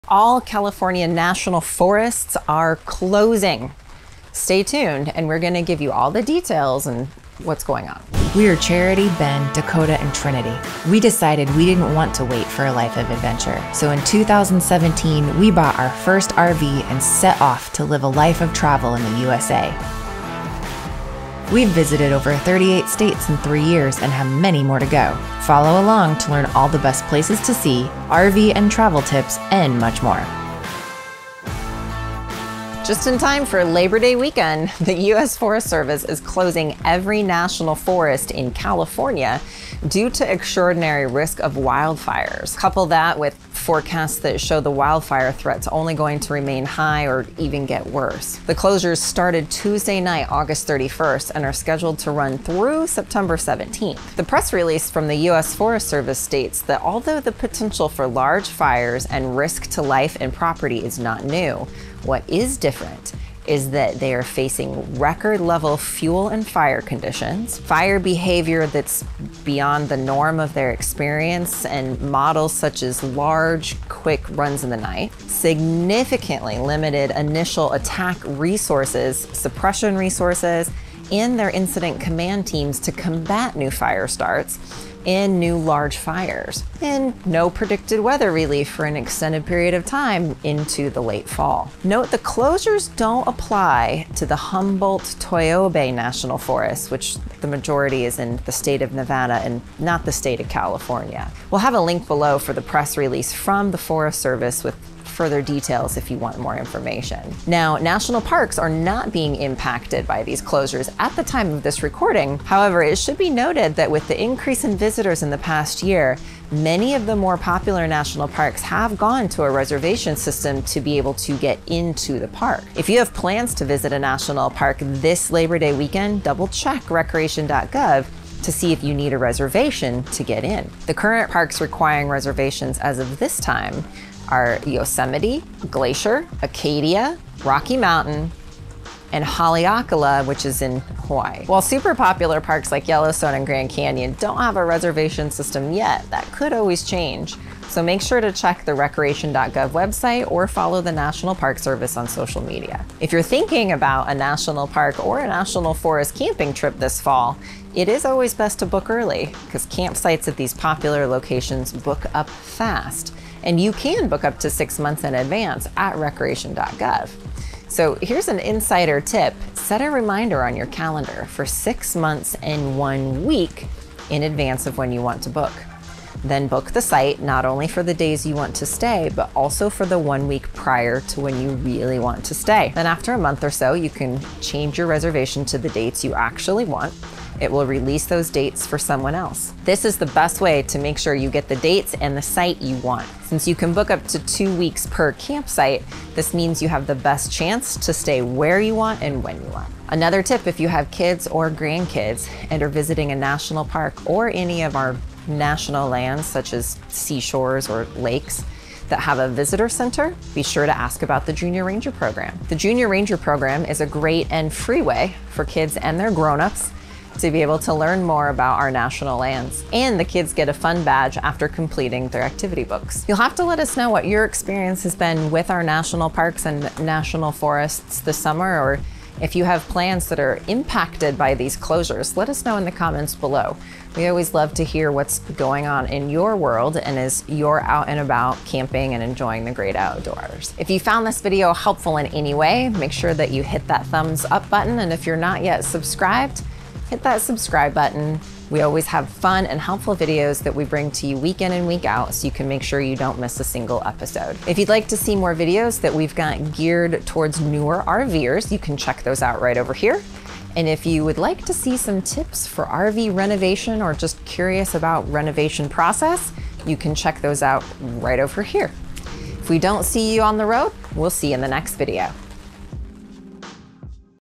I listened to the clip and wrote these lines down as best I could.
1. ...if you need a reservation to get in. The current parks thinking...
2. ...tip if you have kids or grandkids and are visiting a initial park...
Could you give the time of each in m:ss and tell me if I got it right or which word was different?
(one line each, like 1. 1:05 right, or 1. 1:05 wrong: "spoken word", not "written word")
1. 2:08 wrong: "requiring", not "thinking"
2. 3:20 wrong: "national", not "initial".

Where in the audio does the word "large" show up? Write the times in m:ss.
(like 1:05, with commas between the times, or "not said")
0:58, 1:13, 1:25.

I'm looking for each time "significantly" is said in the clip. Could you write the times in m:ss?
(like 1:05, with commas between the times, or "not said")
1:15.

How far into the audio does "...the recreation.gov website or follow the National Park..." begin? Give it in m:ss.
2:28.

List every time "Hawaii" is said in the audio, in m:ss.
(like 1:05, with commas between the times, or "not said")
2:21.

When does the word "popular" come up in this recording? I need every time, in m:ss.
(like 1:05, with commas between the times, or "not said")
1:57, 2:21, 2:40.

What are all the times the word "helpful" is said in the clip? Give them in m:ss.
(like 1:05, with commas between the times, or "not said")
4:01, 4:09.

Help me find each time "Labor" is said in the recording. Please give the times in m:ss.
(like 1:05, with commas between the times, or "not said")
0:33, 2:05.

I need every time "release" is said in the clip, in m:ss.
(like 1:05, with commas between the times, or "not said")
0:54, 1:42, 3:07.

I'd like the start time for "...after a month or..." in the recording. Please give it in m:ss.
3:02.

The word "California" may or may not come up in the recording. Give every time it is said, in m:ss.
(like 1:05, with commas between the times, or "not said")
0:00, 0:38, 1:40.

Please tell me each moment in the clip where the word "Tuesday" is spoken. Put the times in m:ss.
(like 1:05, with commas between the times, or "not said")
0:49.